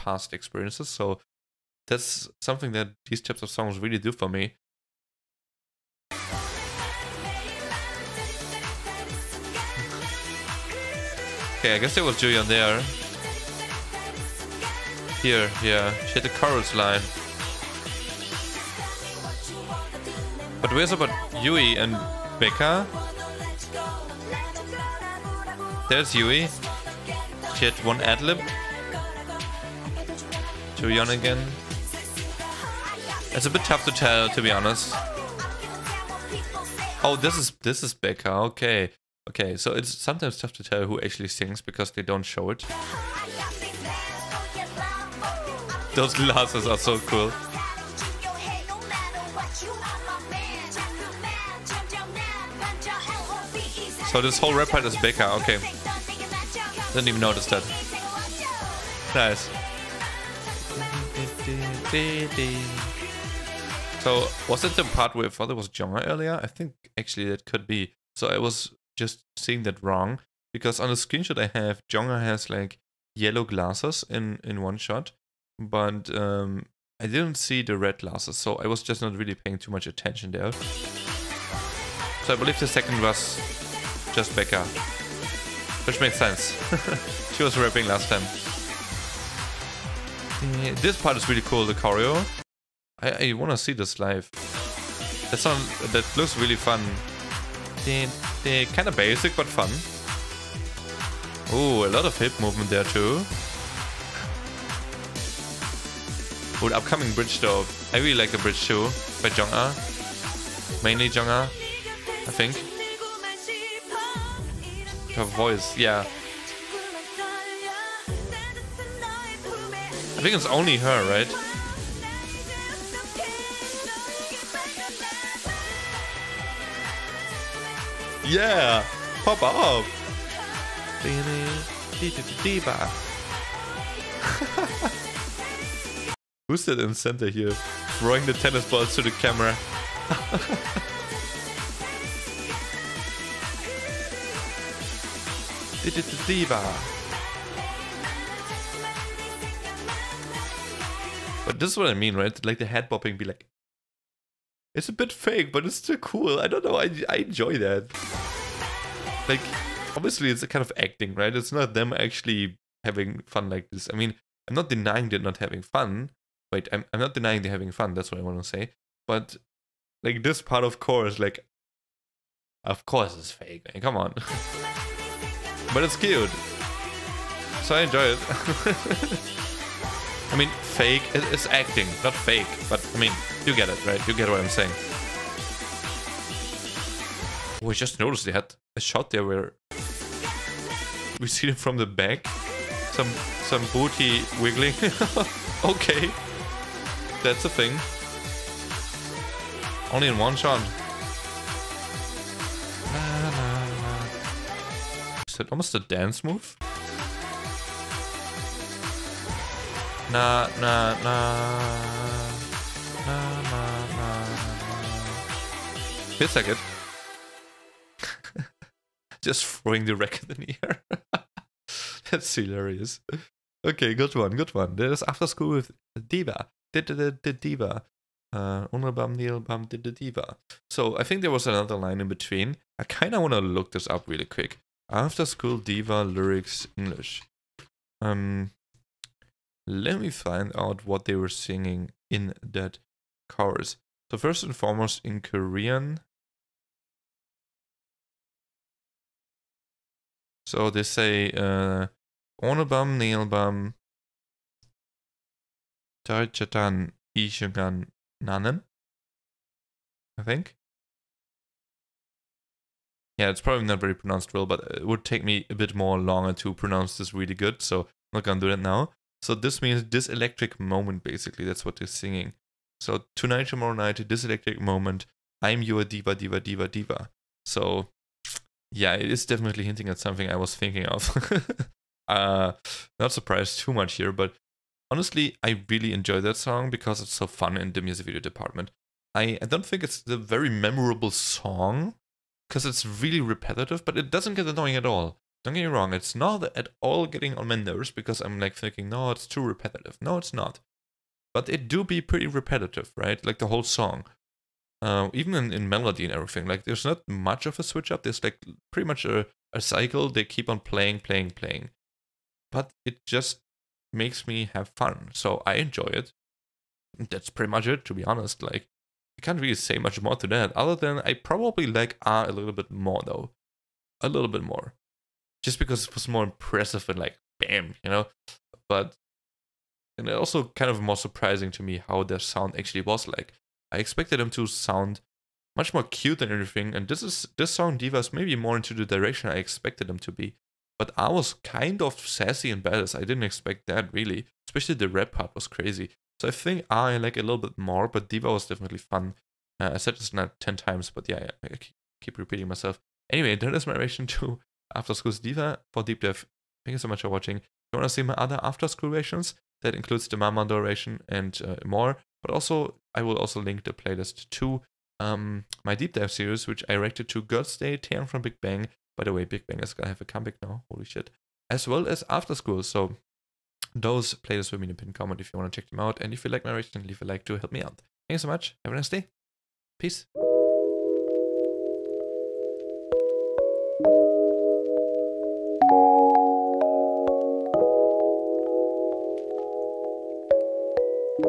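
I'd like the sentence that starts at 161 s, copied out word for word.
It's not them actually having fun like this.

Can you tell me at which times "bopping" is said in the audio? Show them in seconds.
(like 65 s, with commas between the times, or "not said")
152 s.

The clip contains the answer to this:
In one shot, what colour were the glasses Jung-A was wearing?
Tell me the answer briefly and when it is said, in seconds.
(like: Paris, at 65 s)
Yellow, at 73 s.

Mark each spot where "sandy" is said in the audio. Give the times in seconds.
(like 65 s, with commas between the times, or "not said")
not said.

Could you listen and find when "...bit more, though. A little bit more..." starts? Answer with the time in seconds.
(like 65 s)
322 s.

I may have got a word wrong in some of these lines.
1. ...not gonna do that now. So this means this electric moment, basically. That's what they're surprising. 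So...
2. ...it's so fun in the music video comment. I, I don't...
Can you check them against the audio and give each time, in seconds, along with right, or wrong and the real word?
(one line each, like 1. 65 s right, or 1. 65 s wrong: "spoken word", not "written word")
1. 268 s wrong: "singing", not "surprising"
2. 287 s wrong: "department", not "comment".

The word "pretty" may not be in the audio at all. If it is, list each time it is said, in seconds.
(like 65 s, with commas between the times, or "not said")
302 s, 308 s, 317 s.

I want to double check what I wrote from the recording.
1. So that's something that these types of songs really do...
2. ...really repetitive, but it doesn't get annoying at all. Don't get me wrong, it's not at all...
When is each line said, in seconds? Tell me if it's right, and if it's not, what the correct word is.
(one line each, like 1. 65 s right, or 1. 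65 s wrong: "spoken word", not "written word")
1. 0 s right
2. 292 s right.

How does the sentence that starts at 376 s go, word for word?
And if you like my reaction, leave a like to help me out.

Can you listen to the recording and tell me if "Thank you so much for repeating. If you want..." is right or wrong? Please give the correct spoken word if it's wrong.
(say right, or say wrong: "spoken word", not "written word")
wrong: "watching", not "repeating".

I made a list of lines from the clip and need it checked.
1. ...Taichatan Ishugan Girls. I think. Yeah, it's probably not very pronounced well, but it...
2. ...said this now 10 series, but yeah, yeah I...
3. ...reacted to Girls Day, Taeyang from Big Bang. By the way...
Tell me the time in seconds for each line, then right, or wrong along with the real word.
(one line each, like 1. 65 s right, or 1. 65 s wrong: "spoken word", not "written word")
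1. 256 s wrong: "Nanan", not "Girls"
2. 349 s wrong: "times", not "series"
3. 366 s right.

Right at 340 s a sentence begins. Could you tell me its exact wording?
But I was kind of sassy and badass.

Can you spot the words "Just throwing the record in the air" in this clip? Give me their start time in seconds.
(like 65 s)
219 s.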